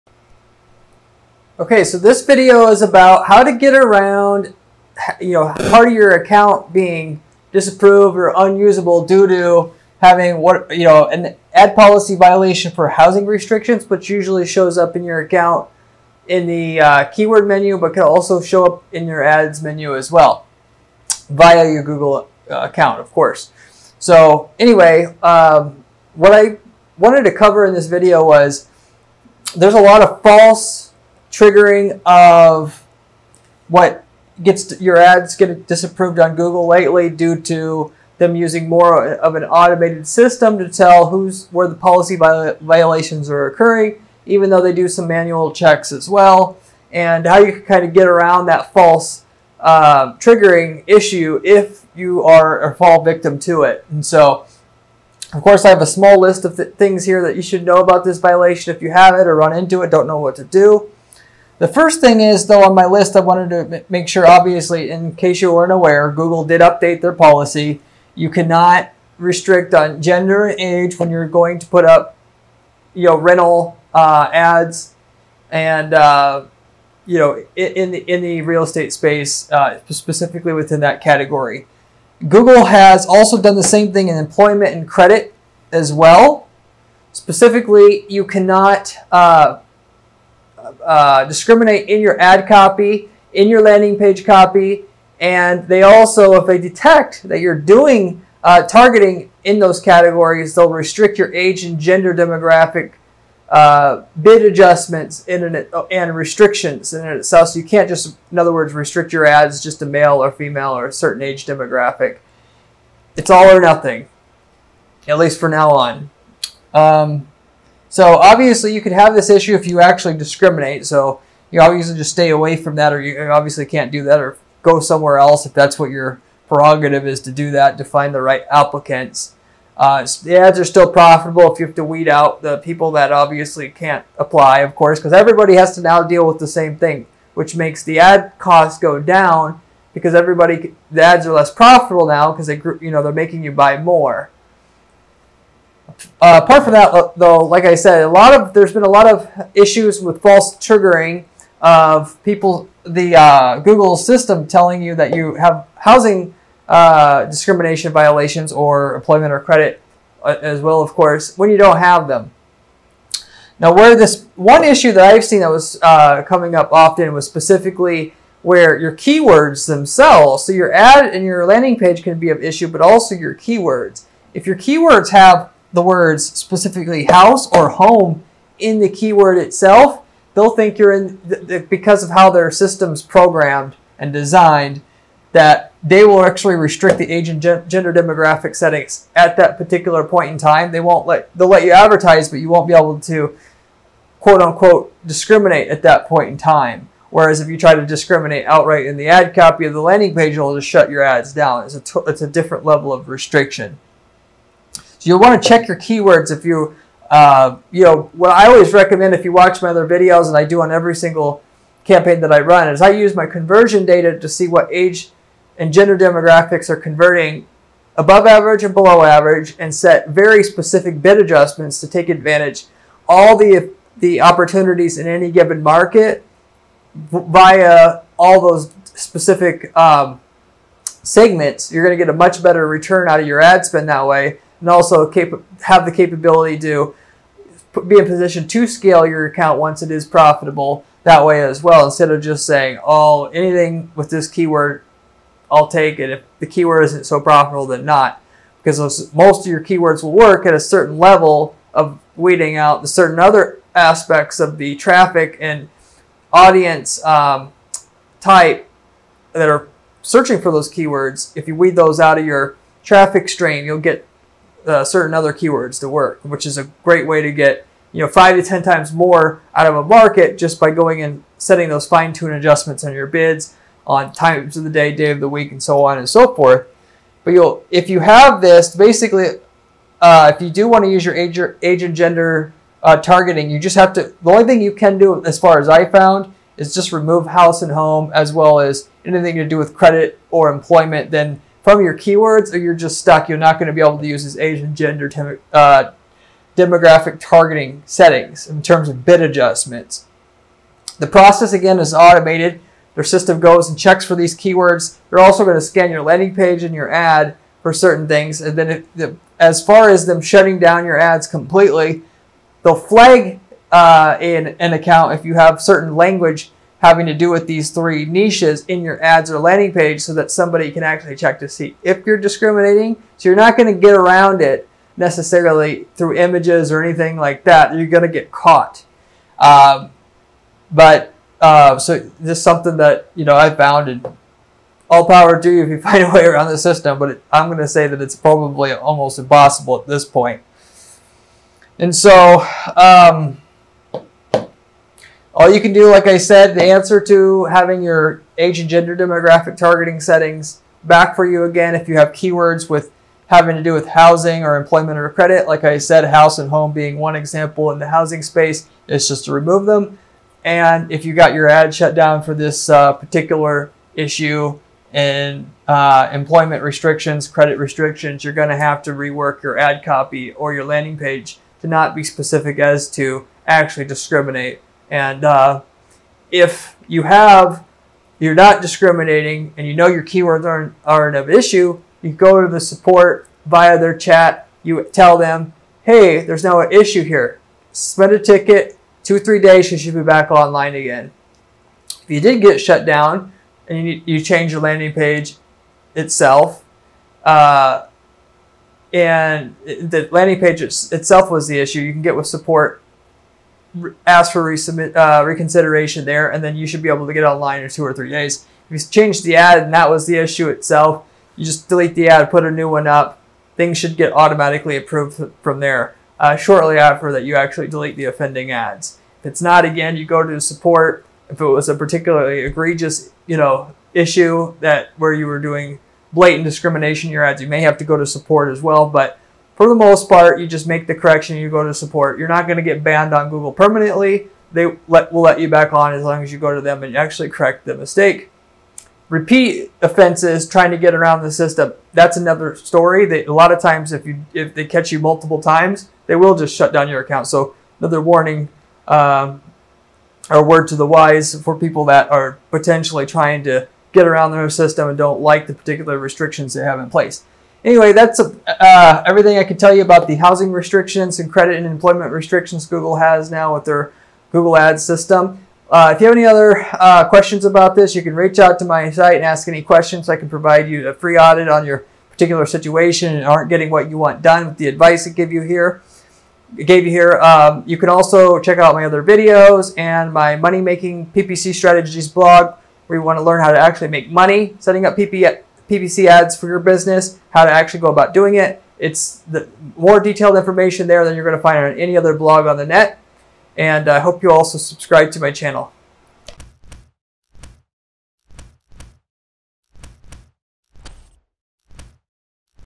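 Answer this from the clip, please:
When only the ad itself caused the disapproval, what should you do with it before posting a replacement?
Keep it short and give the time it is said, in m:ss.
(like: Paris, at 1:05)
delete the ad, at 6:51.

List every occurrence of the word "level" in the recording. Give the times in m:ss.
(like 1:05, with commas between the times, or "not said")
3:22, 4:10.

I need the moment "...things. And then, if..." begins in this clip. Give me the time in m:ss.
5:08.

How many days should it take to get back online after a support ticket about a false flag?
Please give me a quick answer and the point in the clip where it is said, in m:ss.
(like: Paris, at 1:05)
2 or 3 days, at 6:29.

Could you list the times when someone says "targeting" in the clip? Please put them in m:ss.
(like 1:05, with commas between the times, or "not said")
1:38, 4:42, 4:57, 5:49.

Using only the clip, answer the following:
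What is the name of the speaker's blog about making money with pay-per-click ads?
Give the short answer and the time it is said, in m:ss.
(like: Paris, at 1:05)
Money Making PPC Strategies, at 8:00.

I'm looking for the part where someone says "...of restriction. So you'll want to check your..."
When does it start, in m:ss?
3:22.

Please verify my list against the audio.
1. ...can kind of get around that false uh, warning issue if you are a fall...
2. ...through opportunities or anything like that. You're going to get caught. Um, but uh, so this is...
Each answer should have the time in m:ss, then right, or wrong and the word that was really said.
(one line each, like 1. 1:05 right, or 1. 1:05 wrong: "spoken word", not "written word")
1. 0:47 wrong: "triggering", not "warning"
2. 5:25 wrong: "images", not "opportunities".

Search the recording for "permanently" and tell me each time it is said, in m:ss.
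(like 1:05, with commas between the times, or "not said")
7:13.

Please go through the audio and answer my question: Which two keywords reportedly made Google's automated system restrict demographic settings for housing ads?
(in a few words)
house or home.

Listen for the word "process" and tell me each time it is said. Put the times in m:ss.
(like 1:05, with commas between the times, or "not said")
5:01.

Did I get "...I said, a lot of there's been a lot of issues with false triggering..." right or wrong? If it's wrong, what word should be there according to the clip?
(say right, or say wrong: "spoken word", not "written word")
right.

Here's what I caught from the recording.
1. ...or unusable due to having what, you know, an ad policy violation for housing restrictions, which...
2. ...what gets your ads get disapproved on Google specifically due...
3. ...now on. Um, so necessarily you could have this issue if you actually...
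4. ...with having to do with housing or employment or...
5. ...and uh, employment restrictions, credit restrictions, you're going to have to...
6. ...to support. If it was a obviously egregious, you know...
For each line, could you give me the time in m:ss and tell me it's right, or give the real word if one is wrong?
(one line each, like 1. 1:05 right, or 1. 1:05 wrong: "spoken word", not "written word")
1. 0:08 right
2. 0:33 wrong: "lately", not "specifically"
3. 1:55 wrong: "obviously", not "necessarily"
4. 5:52 right
5. 6:04 right
6. 7:00 wrong: "particularly", not "obviously".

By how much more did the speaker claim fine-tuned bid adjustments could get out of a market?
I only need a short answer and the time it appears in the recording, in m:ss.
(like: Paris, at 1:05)
5 to 10 times, at 4:28.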